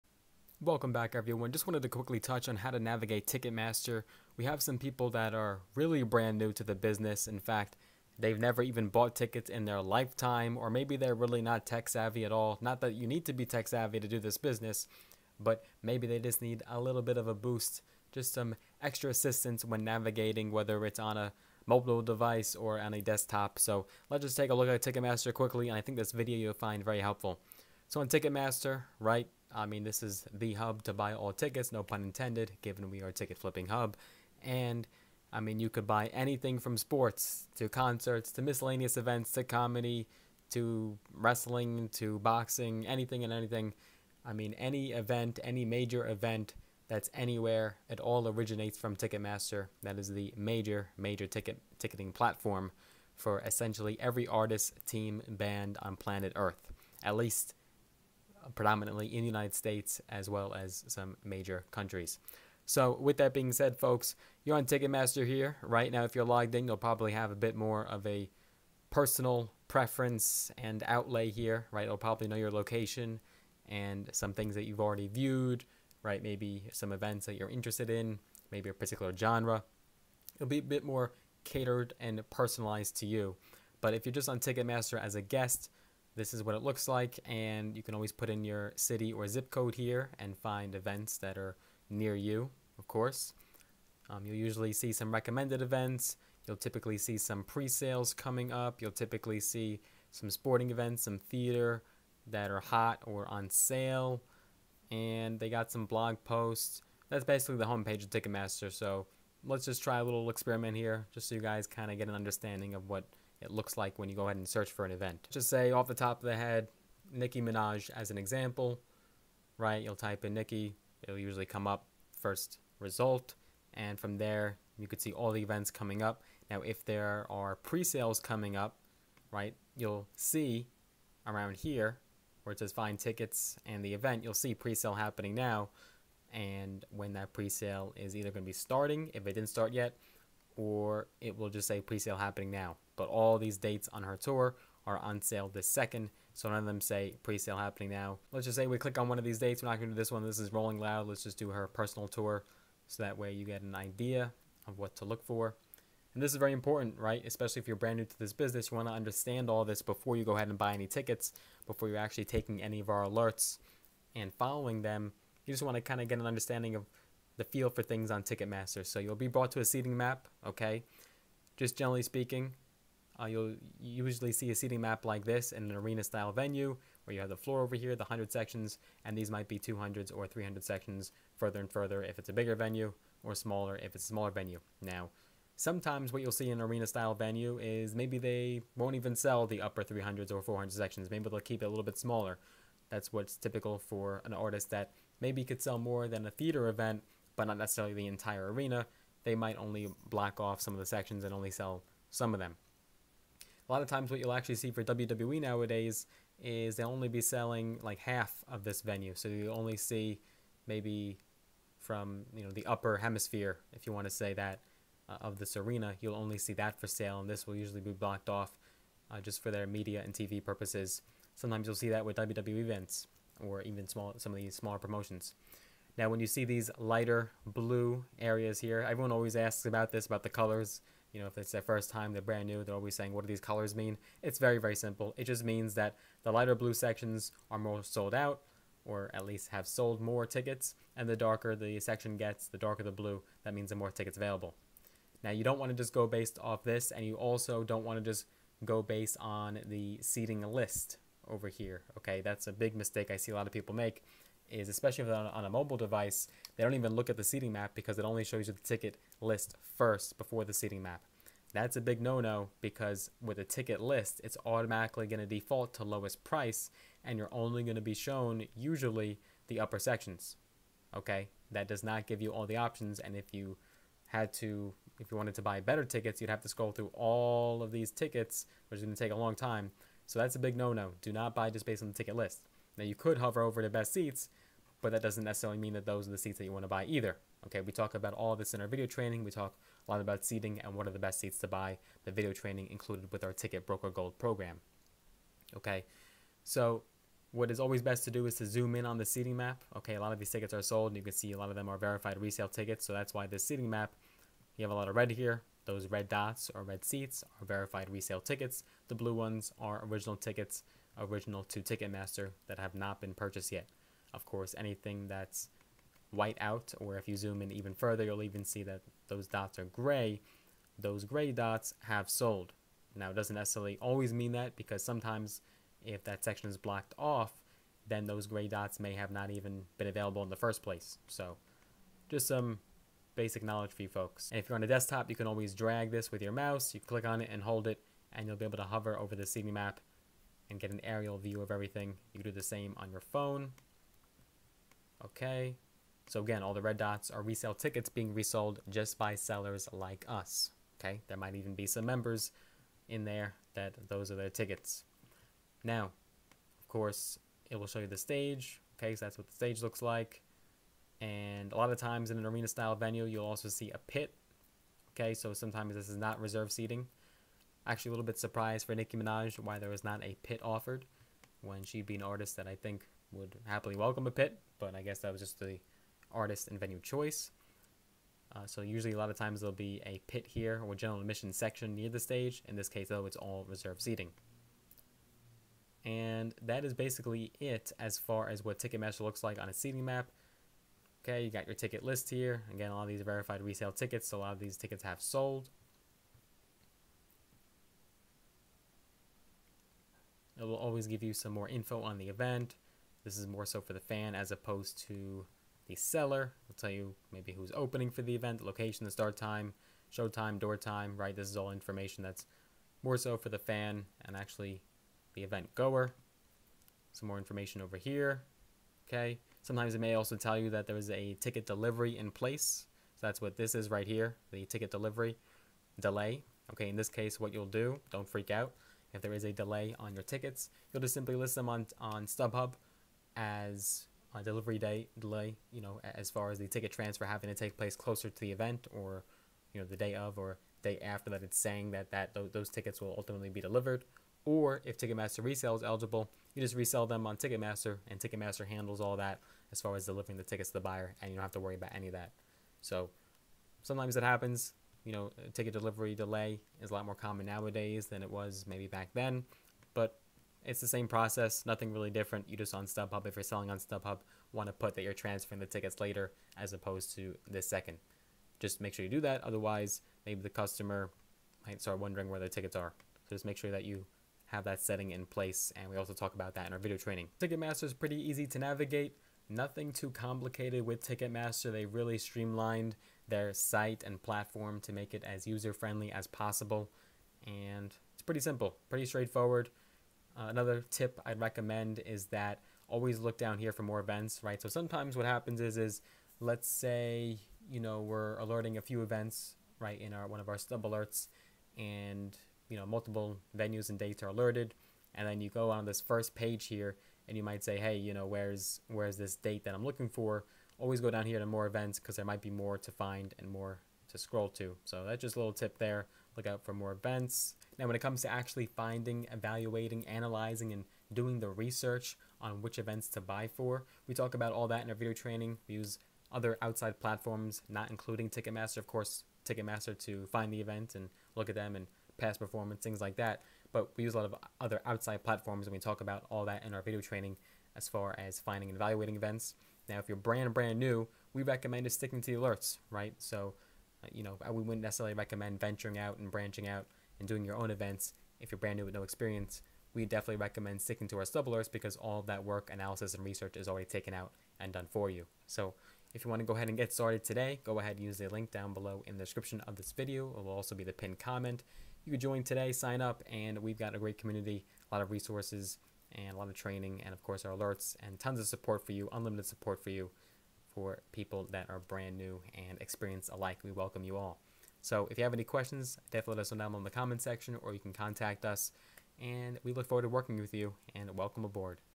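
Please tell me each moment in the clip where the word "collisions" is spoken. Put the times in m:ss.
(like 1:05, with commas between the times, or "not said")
not said.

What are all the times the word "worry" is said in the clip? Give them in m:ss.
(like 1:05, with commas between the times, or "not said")
7:31.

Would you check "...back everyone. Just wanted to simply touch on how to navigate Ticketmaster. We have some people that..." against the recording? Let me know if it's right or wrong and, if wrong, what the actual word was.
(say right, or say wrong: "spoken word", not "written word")
wrong: "quickly", not "simply".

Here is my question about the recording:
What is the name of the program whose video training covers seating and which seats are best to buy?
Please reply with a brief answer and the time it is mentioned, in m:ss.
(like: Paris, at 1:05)
Ticket Broker Gold, at 4:53.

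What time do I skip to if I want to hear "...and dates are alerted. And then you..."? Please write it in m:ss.
8:23.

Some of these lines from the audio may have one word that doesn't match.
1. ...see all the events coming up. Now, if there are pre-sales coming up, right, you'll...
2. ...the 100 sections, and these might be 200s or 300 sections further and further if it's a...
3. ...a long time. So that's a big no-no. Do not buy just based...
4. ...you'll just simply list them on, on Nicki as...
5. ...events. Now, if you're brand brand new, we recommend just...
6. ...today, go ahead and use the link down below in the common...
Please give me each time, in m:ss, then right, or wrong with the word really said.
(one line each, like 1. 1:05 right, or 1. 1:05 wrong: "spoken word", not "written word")
1. 2:05 right
2. 2:57 right
3. 4:39 right
4. 7:10 wrong: "StubHub", not "Nicki"
5. 8:58 right
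6. 9:17 wrong: "description", not "common".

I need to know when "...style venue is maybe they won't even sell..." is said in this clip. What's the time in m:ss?
3:06.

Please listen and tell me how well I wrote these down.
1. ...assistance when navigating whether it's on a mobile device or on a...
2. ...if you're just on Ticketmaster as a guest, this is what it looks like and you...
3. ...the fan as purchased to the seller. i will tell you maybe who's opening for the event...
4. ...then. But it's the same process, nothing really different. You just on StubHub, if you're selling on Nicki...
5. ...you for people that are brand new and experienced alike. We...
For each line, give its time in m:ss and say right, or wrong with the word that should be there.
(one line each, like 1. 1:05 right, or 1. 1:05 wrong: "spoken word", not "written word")
1. 0:19 right
2. 1:23 right
3. 6:43 wrong: "opposed", not "purchased"
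4. 7:38 wrong: "StubHub", not "Nicki"
5. 9:29 right.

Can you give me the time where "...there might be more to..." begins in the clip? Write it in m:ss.
8:31.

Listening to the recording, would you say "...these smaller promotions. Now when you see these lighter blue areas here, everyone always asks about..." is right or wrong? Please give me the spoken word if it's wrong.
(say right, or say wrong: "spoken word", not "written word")
right.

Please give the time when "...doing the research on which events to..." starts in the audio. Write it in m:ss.
8:40.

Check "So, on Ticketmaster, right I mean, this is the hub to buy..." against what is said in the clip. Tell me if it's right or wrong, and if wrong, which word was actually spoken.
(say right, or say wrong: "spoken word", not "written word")
right.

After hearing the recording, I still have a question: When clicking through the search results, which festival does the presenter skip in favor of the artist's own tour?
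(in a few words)
Rolling Loud.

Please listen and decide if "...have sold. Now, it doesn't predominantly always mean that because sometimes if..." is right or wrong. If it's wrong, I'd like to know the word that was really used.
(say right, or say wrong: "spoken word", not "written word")
wrong: "necessarily", not "predominantly".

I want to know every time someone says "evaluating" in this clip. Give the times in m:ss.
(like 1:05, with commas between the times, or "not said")
8:39, 8:58.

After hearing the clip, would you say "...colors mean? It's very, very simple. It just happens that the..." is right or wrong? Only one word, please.
wrong.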